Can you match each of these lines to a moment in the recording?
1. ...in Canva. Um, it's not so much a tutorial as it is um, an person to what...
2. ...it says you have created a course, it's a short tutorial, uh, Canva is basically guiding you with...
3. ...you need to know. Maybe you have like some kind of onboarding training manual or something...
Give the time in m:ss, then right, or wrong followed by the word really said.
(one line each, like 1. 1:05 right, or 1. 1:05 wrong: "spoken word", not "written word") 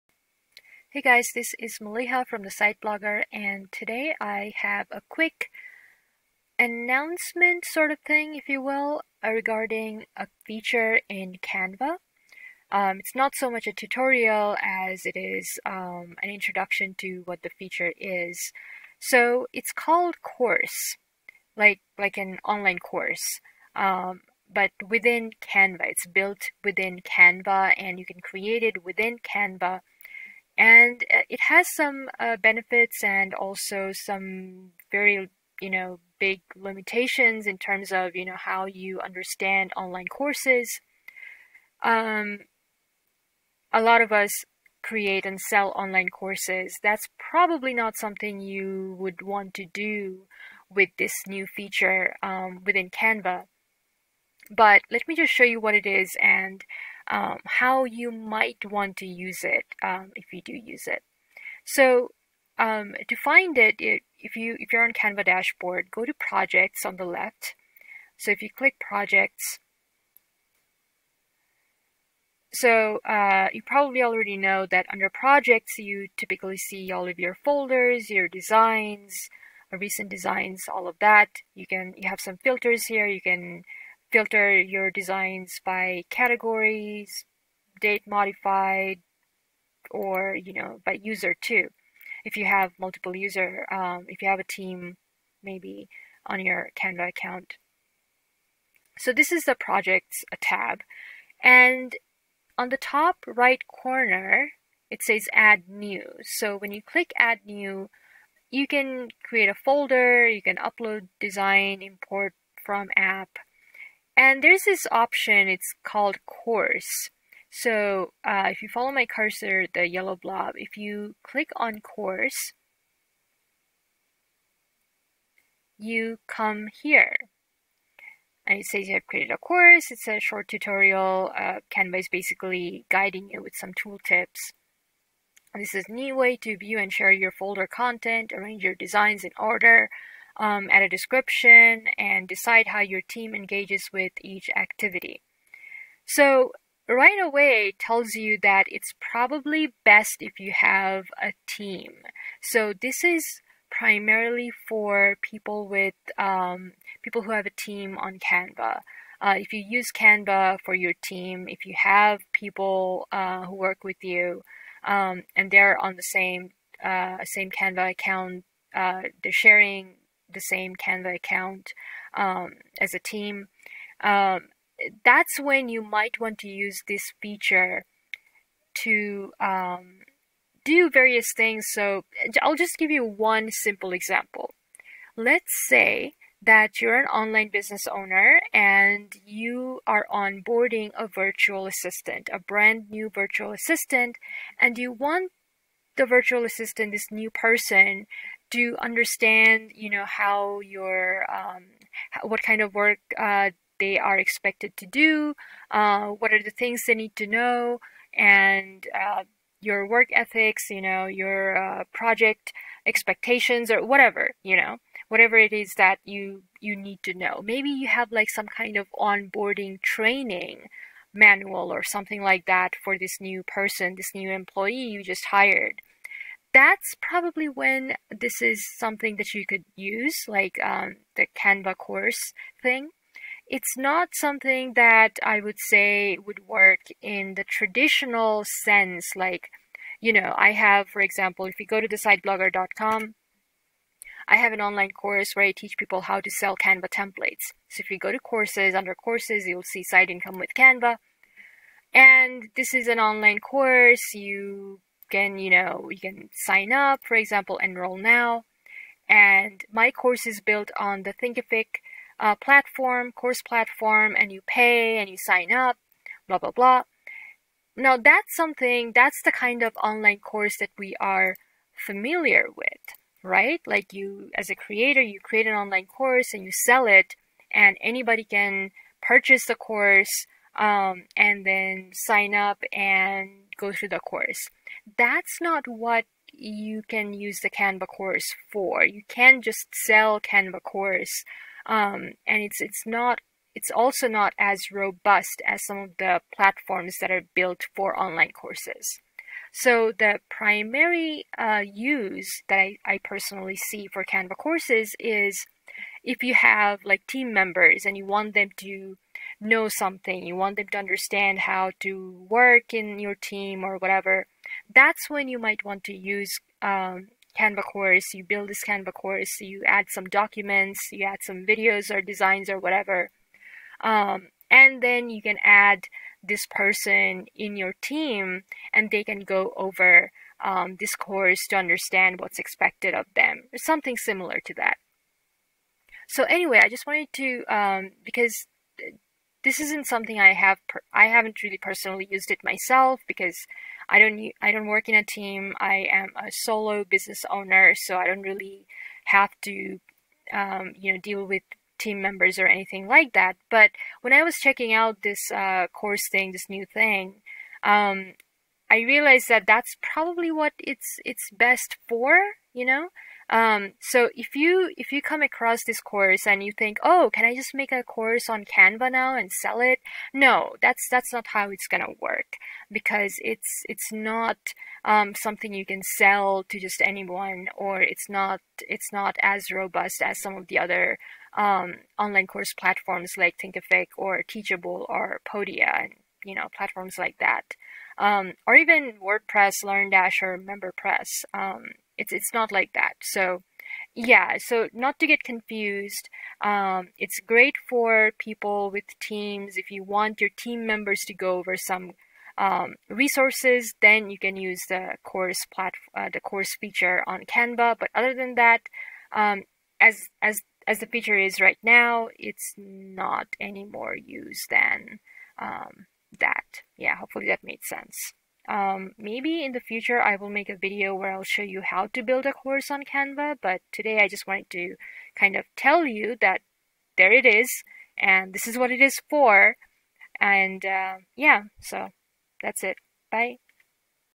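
1. 0:11 wrong: "introduction", not "person"
2. 2:08 right
3. 3:36 right.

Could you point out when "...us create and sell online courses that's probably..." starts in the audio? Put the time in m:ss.
0:44.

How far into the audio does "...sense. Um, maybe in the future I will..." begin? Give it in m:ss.
6:57.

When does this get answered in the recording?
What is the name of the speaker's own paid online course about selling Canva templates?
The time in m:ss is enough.
4:09.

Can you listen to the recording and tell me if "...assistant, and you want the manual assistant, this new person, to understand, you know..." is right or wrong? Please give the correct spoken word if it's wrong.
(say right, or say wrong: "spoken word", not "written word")
wrong: "virtual", not "manual".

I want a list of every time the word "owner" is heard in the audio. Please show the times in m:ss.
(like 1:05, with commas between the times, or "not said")
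3:07, 5:47.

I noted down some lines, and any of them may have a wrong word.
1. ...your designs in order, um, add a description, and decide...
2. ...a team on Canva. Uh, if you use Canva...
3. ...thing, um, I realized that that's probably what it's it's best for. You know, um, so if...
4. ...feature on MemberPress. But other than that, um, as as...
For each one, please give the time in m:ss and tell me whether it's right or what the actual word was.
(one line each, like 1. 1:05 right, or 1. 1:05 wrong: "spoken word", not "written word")
1. 2:18 right
2. 2:37 right
3. 5:56 right
4. 6:46 wrong: "Canva", not "MemberPress".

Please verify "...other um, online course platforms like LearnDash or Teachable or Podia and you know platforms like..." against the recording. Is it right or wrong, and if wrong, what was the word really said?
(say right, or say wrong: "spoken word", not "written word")
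wrong: "Thinkific", not "LearnDash".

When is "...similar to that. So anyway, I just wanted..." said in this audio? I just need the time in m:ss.
5:33.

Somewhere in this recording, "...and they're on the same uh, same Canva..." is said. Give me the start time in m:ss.
2:45.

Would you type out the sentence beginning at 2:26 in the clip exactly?
So right away tells you that it's probably best if you have a team.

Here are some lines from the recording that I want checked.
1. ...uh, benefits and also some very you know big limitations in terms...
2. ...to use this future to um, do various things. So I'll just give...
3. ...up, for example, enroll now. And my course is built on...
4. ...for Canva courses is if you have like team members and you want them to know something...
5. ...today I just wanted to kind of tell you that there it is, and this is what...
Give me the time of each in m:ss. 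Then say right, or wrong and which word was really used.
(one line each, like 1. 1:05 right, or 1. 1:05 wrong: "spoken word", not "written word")
1. 0:32 right
2. 2:56 wrong: "feature", not "future"
3. 4:16 right
4. 5:03 right
5. 7:03 right.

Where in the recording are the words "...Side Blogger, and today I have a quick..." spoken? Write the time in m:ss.
0:02.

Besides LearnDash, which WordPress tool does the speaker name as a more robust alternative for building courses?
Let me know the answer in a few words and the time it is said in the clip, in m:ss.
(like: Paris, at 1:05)
MemberPress, at 6:30.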